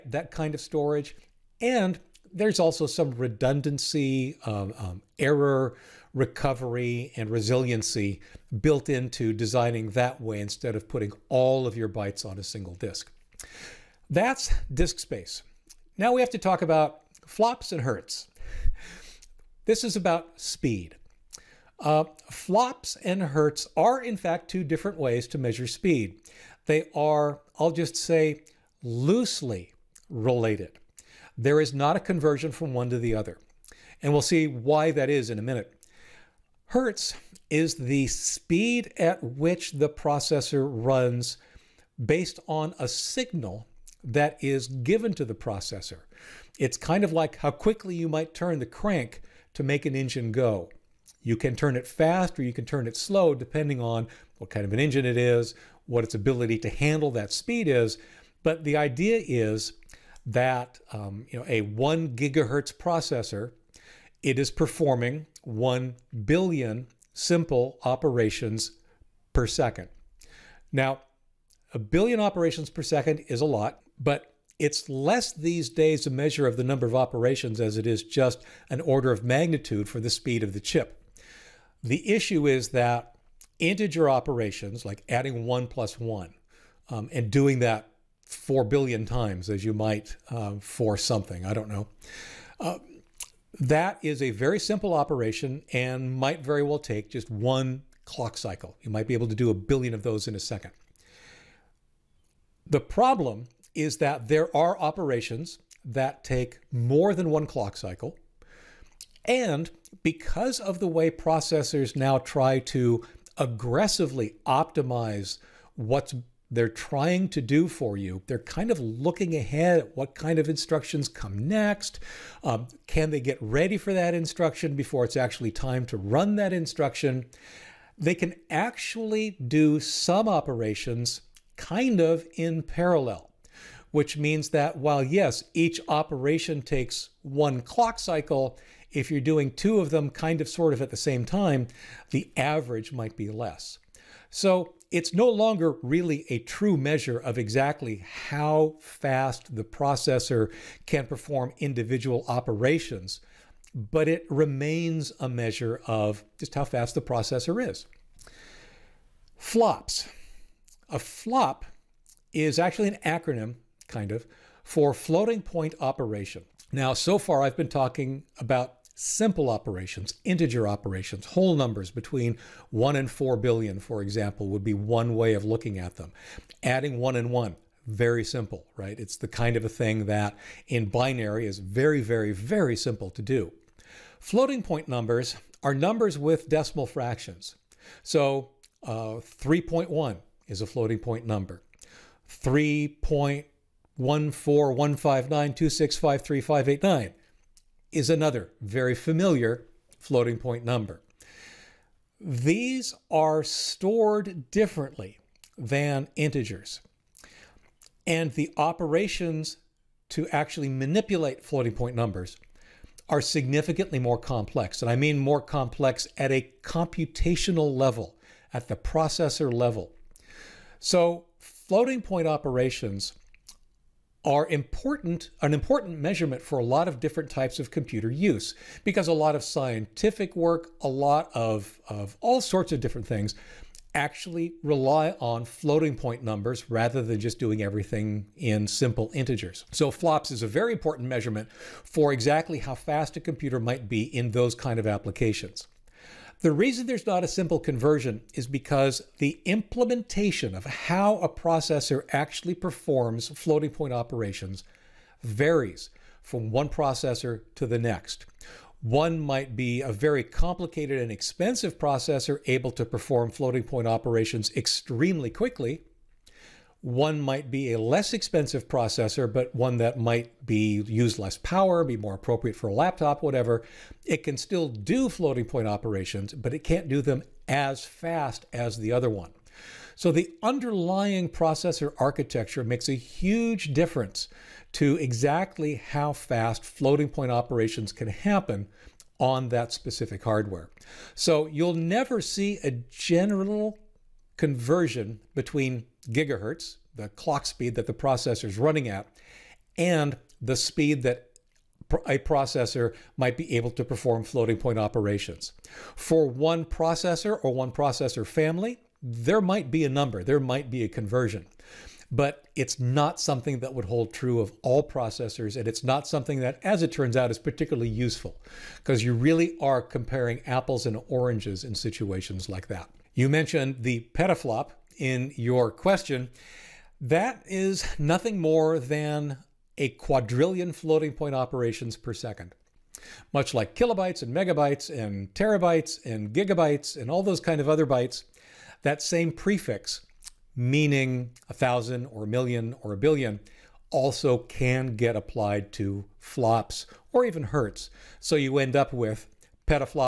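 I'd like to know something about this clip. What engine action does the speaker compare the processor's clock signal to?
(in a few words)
turn the crank.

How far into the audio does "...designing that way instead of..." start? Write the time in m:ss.
0:09.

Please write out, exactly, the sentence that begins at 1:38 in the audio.
You might be able to do a billion of those in a second.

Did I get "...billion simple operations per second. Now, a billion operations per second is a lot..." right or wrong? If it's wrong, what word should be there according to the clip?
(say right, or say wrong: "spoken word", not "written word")
right.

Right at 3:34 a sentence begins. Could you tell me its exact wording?
And I mean more complex at a computational level, at the processor level.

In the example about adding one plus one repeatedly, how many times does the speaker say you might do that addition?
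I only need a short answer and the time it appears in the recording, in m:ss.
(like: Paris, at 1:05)
4 billion, at 1:28.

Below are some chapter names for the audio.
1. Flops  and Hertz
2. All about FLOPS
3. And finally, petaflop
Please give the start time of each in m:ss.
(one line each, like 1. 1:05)
1. 0:16
2. 2:38
3. 5:24.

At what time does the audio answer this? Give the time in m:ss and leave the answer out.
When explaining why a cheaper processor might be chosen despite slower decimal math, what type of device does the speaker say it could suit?
4:32.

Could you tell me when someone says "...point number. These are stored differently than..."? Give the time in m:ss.
3:20.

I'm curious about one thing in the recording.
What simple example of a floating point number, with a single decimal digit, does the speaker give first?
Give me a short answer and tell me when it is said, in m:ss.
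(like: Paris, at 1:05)
3.1, at 3:09.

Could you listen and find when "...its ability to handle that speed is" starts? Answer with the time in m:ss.
0:56.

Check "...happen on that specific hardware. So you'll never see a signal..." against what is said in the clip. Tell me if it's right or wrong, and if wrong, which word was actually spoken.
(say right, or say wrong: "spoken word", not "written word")
wrong: "general", not "signal".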